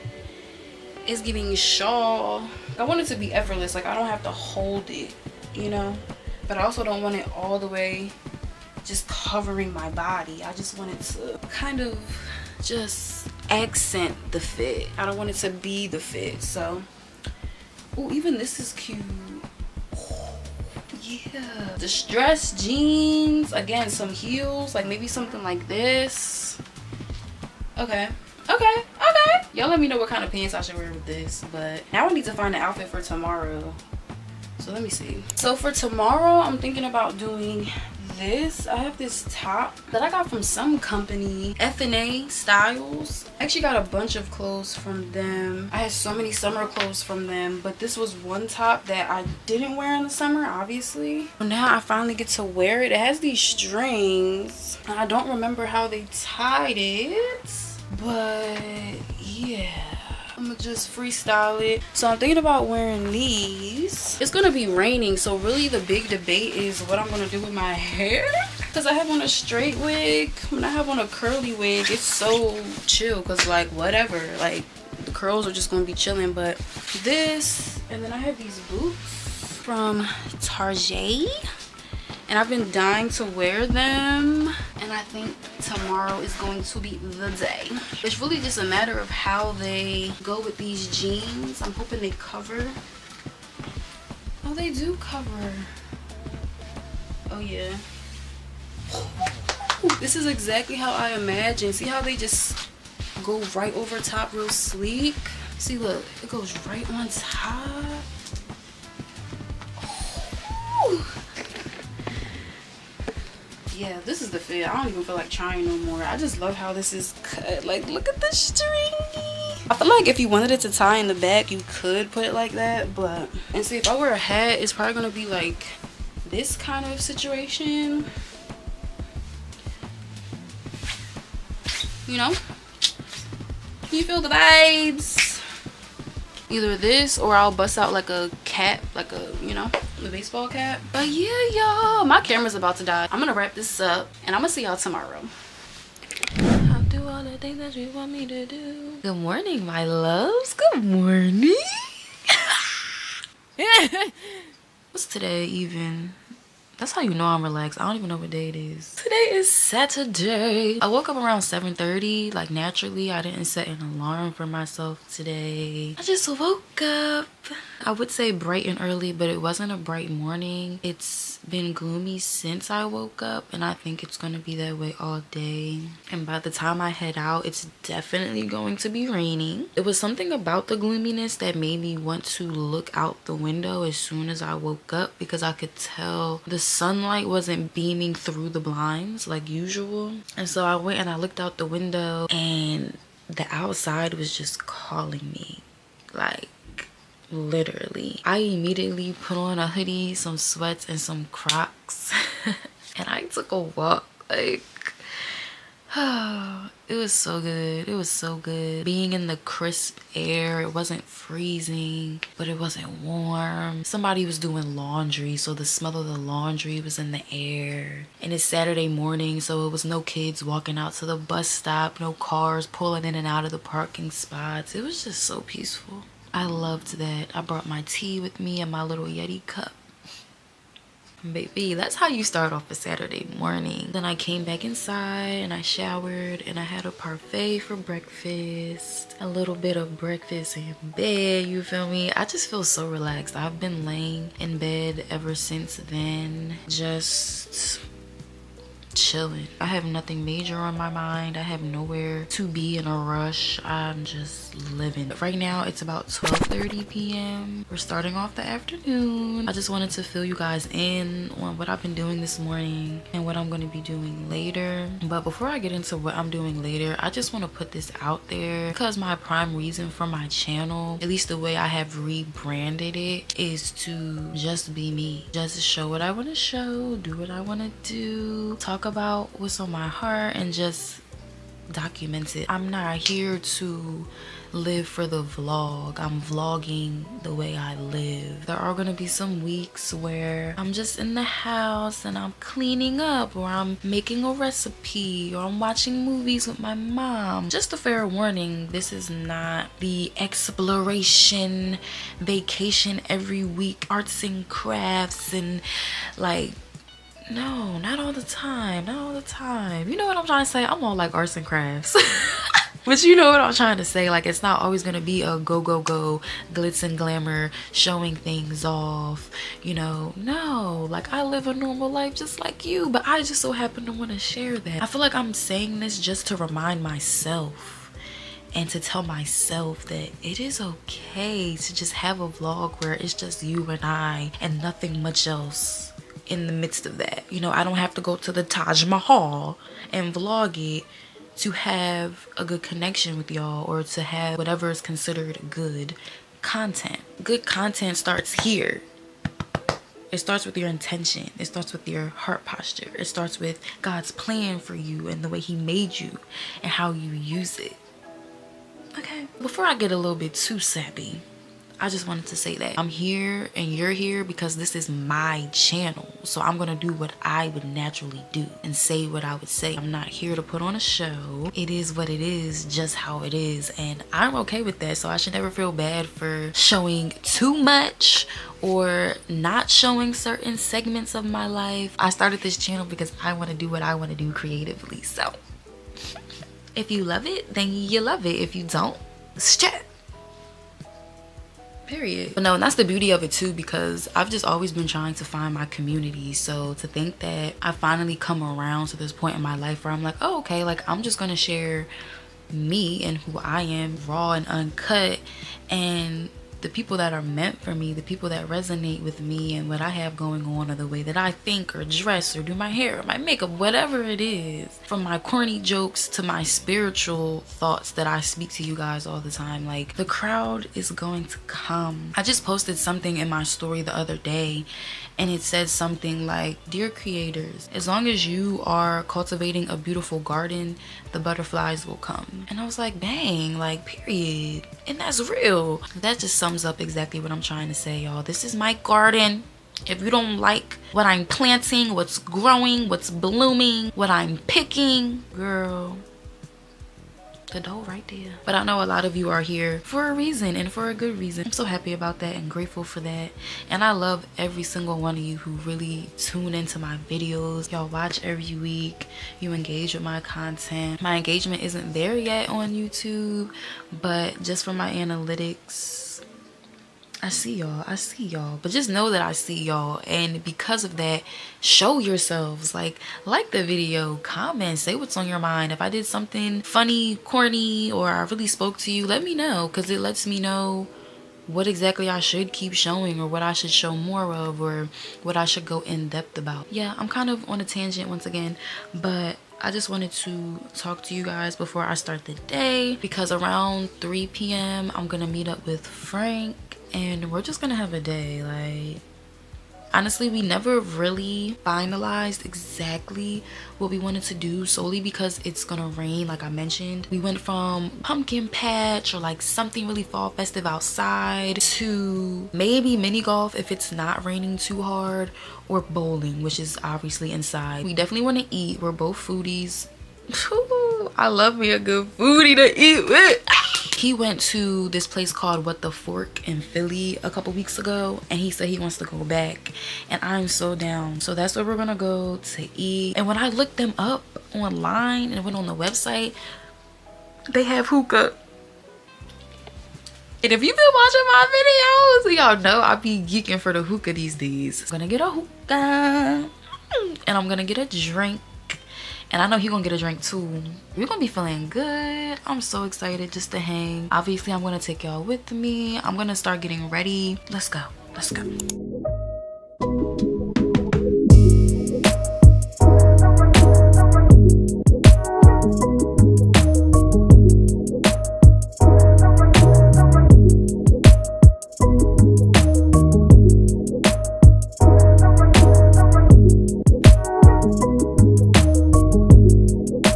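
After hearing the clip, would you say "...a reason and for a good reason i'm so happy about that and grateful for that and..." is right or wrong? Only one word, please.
right.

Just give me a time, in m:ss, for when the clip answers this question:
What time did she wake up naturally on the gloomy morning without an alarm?
2:41.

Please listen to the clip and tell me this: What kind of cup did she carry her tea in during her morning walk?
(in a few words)
Yeti cup.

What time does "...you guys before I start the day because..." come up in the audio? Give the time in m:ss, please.
8:11.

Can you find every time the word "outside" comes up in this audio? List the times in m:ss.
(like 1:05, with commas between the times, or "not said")
3:13, 8:30.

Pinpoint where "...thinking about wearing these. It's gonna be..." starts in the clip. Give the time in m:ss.
1:02.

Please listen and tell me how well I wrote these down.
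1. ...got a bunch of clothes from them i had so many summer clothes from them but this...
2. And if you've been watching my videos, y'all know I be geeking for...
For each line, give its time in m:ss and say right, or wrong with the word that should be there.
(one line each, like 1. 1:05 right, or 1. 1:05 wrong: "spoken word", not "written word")
1. 0:43 right
2. 9:00 right.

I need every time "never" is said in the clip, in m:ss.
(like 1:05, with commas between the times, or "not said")
6:15, 8:20.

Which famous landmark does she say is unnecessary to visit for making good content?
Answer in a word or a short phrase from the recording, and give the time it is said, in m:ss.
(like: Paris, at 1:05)
Taj Mahal, at 5:38.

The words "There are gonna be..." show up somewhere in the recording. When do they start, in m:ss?
4:48.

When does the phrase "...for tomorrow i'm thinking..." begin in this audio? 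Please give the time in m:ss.
0:35.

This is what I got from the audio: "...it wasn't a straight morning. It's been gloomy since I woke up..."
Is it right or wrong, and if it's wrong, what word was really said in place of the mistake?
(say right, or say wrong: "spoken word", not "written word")
wrong: "bright", not "straight".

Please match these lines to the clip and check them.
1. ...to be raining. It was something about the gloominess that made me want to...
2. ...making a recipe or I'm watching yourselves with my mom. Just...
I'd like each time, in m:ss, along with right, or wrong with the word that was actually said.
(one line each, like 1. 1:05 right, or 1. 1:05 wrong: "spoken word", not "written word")
1. 2:58 right
2. 4:53 wrong: "movies", not "yourselves".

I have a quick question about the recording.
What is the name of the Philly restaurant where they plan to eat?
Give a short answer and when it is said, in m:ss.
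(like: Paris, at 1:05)
What the Fork, at 8:45.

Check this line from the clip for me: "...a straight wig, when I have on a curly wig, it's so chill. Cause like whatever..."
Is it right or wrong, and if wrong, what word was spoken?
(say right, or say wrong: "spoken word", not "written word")
right.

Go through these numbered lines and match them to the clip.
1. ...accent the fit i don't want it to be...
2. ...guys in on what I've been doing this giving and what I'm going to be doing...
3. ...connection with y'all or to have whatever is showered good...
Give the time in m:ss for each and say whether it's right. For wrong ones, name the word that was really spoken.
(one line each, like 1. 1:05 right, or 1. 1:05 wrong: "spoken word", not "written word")
1. 0:13 right
2. 4:20 wrong: "morning", not "giving"
3. 5:42 wrong: "considered", not "showered".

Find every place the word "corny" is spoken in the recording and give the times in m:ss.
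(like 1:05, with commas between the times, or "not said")
6:55, 7:57.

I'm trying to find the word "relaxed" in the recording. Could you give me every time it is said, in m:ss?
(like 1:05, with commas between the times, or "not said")
2:37, 4:02.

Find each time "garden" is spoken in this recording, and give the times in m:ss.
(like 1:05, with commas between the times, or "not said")
7:10, 7:18.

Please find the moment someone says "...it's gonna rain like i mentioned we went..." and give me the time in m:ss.
8:25.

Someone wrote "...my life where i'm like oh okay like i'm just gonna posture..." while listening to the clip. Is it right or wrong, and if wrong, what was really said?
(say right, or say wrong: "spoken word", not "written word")
wrong: "share", not "posture".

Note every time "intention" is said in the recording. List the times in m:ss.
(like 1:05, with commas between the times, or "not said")
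5:50.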